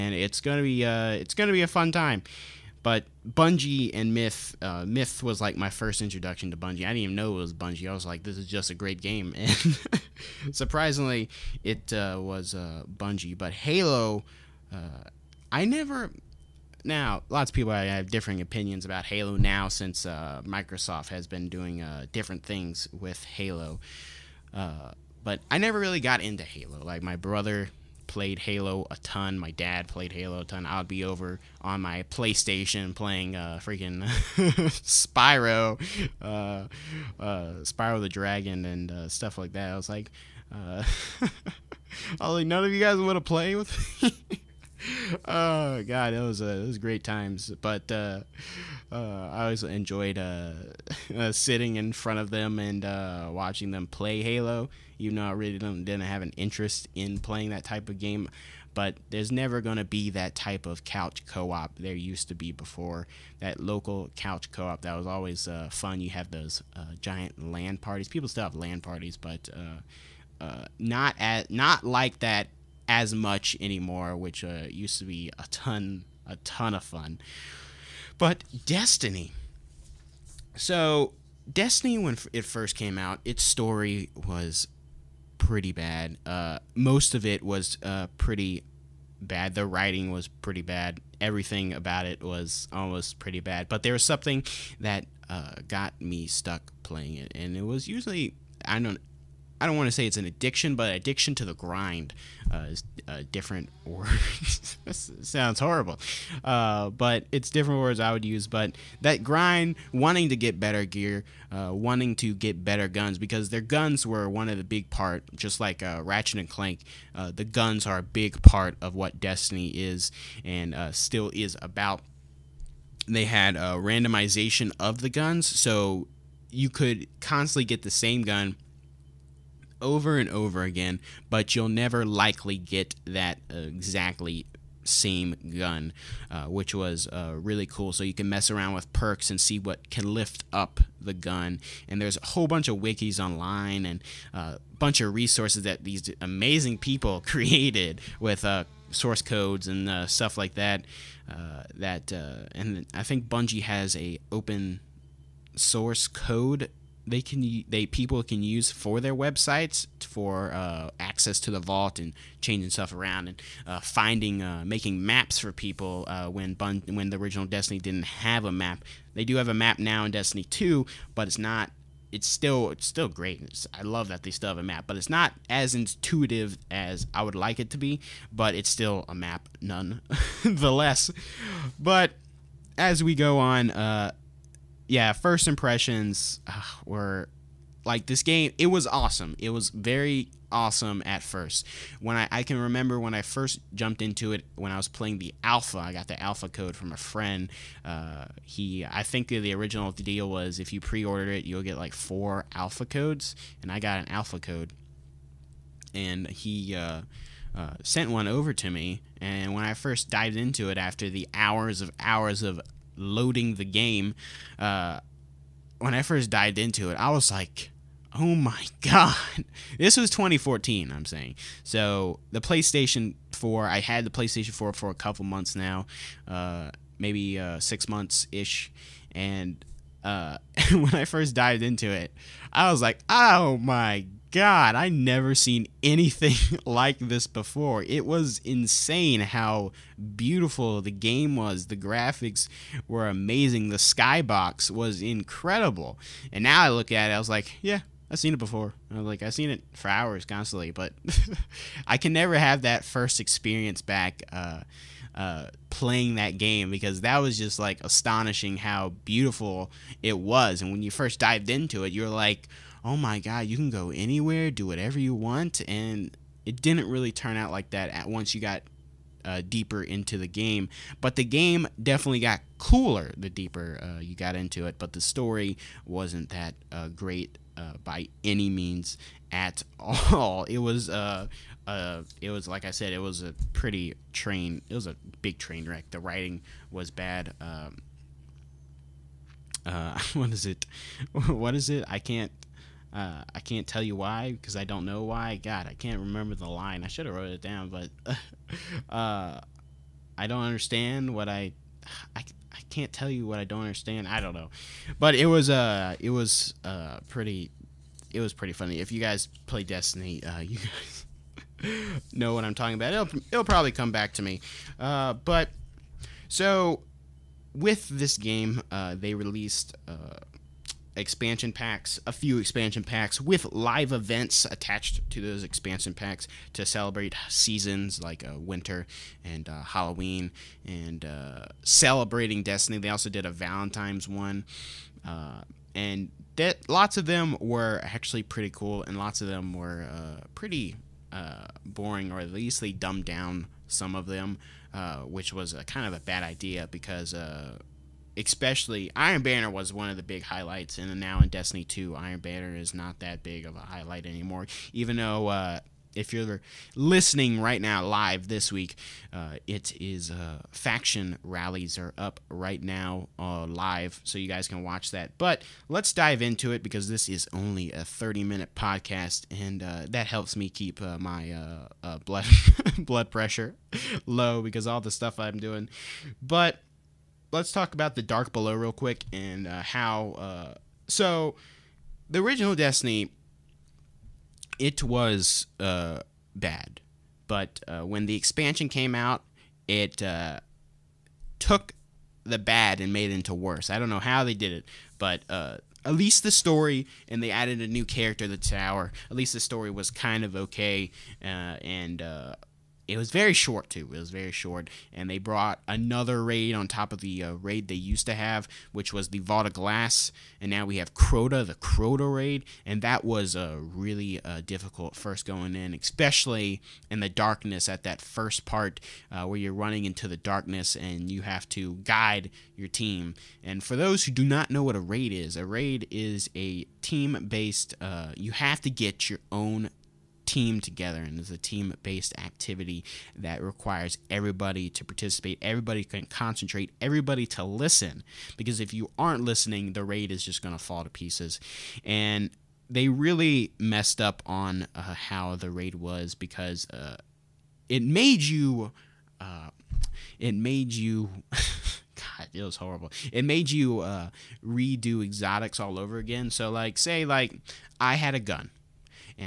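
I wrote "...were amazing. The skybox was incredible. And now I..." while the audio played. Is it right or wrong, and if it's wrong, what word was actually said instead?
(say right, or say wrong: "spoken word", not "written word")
right.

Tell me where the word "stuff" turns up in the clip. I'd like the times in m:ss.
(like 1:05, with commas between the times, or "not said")
0:39, 2:30, 2:42, 6:14.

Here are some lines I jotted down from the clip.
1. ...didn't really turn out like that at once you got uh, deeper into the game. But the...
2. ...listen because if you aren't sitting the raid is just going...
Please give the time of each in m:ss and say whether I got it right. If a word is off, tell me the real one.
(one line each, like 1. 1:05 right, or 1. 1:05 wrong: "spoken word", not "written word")
1. 4:26 right
2. 7:17 wrong: "listening", not "sitting".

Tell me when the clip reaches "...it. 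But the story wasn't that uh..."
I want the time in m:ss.
4:34.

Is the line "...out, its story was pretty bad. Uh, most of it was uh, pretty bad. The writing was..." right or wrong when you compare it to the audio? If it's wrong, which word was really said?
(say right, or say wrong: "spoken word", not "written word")
right.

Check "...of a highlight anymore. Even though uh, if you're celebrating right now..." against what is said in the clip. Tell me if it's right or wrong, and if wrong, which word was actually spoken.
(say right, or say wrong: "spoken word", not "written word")
wrong: "listening", not "celebrating".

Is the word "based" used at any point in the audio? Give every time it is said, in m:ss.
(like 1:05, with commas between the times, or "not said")
7:06, 7:11.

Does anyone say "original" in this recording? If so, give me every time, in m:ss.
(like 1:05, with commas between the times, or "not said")
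2:47, 3:19, 6:22.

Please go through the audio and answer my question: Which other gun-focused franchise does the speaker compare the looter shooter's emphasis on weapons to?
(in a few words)
Ratchet and Clank.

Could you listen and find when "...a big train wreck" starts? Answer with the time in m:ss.
4:44.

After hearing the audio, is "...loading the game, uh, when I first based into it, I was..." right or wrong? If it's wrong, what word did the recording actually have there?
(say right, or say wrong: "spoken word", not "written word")
wrong: "dived", not "based".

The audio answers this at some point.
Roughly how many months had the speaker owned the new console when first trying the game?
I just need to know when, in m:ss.
3:47.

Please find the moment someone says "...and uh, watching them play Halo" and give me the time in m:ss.
0:52.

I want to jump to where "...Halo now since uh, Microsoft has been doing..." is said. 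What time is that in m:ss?
0:19.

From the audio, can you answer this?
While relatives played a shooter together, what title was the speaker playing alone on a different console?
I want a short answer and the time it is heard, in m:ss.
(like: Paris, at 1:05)
Spyro the Dragon, at 0:37.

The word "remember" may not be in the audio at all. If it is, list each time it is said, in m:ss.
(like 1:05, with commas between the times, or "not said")
3:12, 4:55.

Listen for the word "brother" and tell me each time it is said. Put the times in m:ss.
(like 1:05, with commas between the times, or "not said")
0:27.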